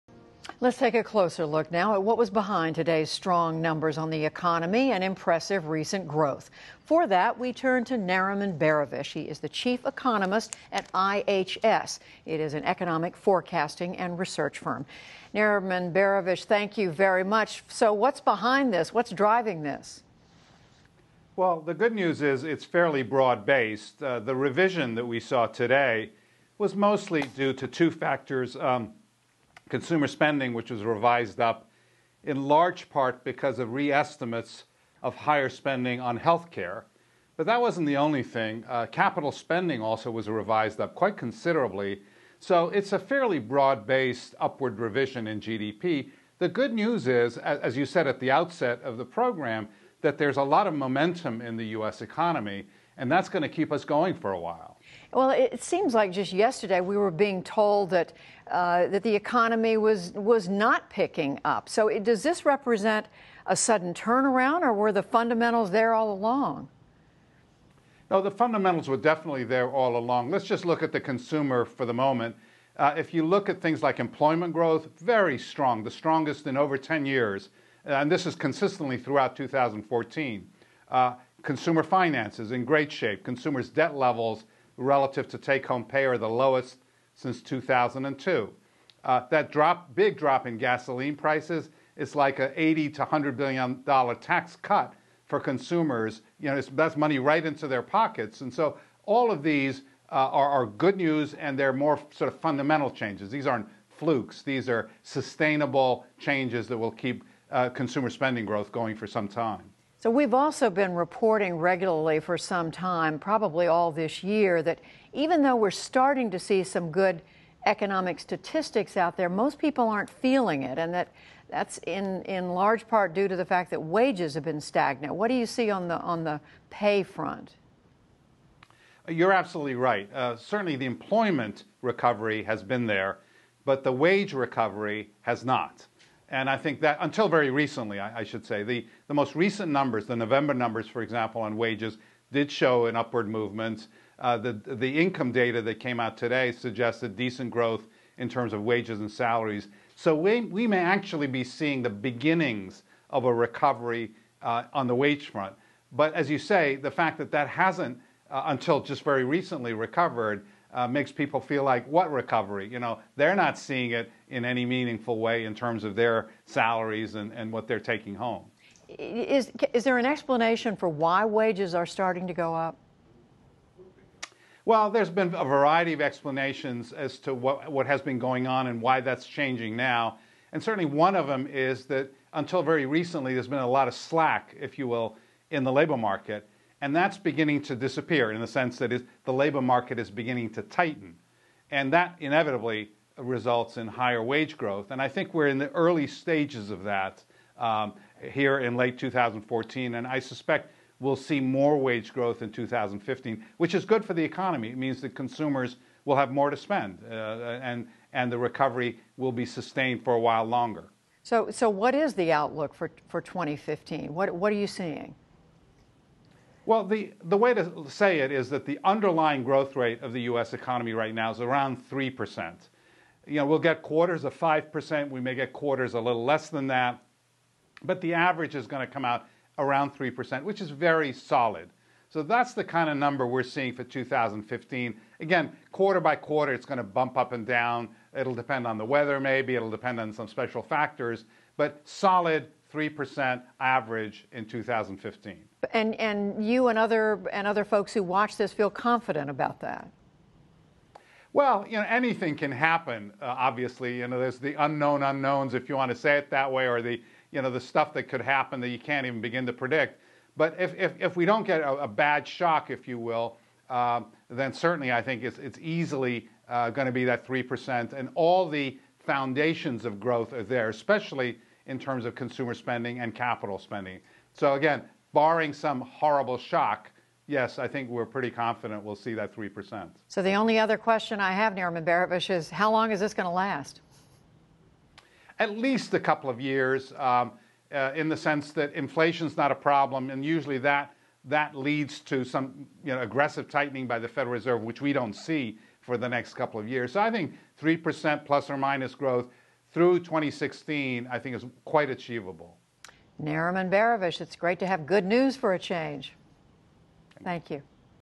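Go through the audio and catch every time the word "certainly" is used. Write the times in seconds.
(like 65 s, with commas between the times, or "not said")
130 s, 180 s, 264 s.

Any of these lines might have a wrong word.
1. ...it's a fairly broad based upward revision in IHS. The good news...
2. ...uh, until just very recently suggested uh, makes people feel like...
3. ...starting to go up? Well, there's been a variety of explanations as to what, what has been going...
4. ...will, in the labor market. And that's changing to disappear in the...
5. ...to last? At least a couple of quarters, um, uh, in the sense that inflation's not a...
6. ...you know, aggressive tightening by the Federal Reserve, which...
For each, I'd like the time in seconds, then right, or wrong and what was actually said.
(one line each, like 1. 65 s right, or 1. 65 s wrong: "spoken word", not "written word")
1. 42 s wrong: "GDP", not "IHS"
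2. 158 s wrong: "recovered", not "suggested"
3. 171 s right
4. 184 s wrong: "beginning", not "changing"
5. 283 s wrong: "years", not "quarters"
6. 292 s right.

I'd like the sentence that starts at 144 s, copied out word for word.
Uh, the, the income data that came out today suggested decent growth in terms of wages and salaries.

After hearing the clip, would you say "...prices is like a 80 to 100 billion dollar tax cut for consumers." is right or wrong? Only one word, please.
right.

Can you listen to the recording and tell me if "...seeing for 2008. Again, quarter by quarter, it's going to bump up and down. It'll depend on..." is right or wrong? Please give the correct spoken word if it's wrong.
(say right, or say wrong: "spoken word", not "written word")
wrong: "2015", not "2008".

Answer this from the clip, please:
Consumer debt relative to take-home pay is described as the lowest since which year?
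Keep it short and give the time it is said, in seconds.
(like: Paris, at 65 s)
2002, at 87 s.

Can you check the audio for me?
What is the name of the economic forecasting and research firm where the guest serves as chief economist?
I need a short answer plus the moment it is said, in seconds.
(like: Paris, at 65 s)
IHS, at 10 s.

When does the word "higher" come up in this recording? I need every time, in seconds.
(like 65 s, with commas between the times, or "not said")
35 s, 193 s.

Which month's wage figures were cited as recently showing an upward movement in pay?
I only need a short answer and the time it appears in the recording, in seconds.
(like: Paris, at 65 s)
November, at 140 s.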